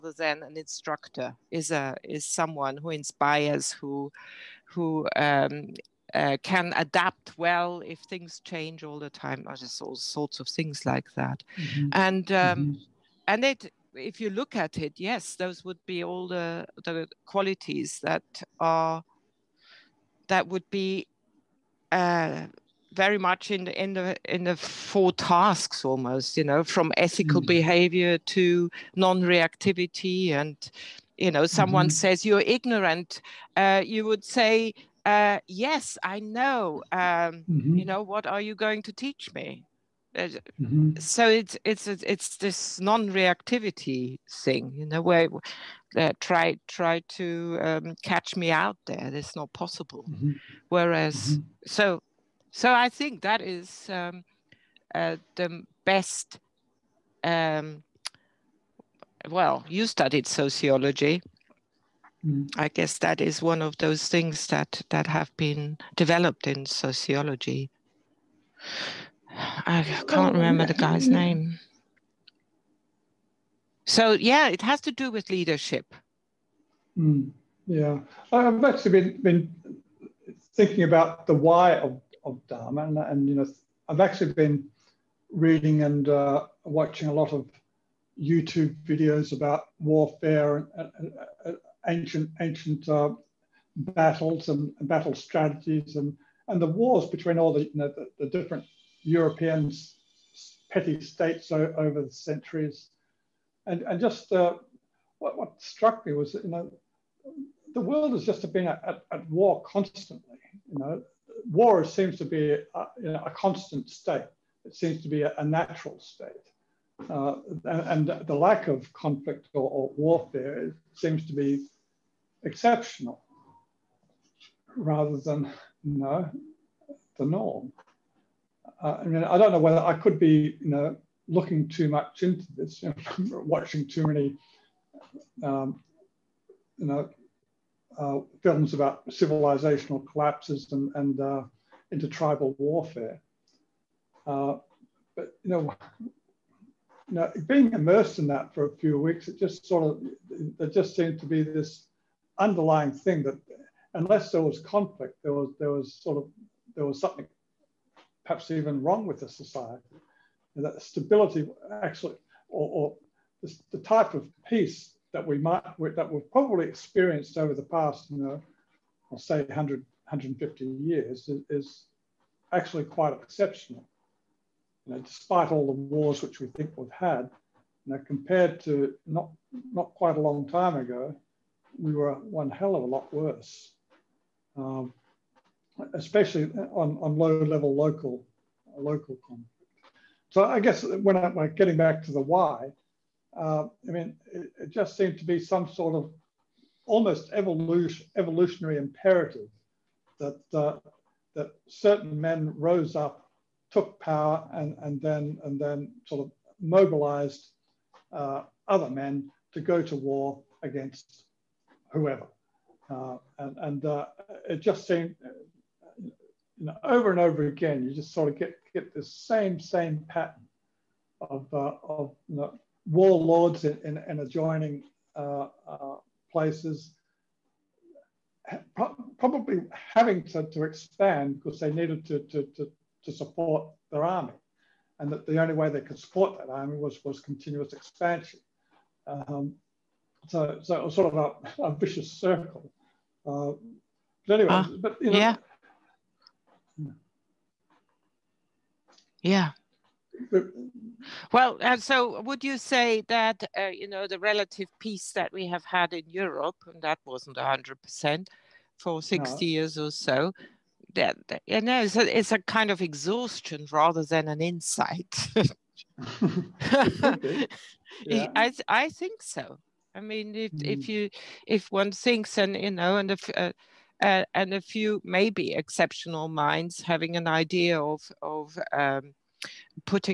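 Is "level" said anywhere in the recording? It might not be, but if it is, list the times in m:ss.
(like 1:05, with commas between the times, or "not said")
3:07.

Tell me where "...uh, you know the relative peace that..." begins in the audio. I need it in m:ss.
4:13.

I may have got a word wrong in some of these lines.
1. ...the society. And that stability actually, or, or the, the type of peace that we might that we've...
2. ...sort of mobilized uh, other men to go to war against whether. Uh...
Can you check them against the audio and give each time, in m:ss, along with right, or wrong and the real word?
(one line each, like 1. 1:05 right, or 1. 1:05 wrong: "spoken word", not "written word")
1. 2:39 right
2. 3:26 wrong: "whoever", not "whether".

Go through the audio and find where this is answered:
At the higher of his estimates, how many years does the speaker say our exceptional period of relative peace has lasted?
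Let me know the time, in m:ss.
2:49.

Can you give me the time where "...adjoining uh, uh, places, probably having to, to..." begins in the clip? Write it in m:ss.
3:44.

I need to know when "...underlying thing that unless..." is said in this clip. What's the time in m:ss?
2:32.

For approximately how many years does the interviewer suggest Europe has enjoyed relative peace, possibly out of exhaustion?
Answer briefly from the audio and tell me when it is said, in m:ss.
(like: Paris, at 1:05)
60 years, at 4:19.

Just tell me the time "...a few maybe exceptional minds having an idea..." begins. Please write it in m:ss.
4:34.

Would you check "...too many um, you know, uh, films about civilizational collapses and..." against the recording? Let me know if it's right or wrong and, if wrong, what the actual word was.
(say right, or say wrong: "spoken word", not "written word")
right.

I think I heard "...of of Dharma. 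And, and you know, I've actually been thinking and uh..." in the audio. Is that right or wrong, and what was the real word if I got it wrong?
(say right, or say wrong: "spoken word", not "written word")
wrong: "reading", not "thinking".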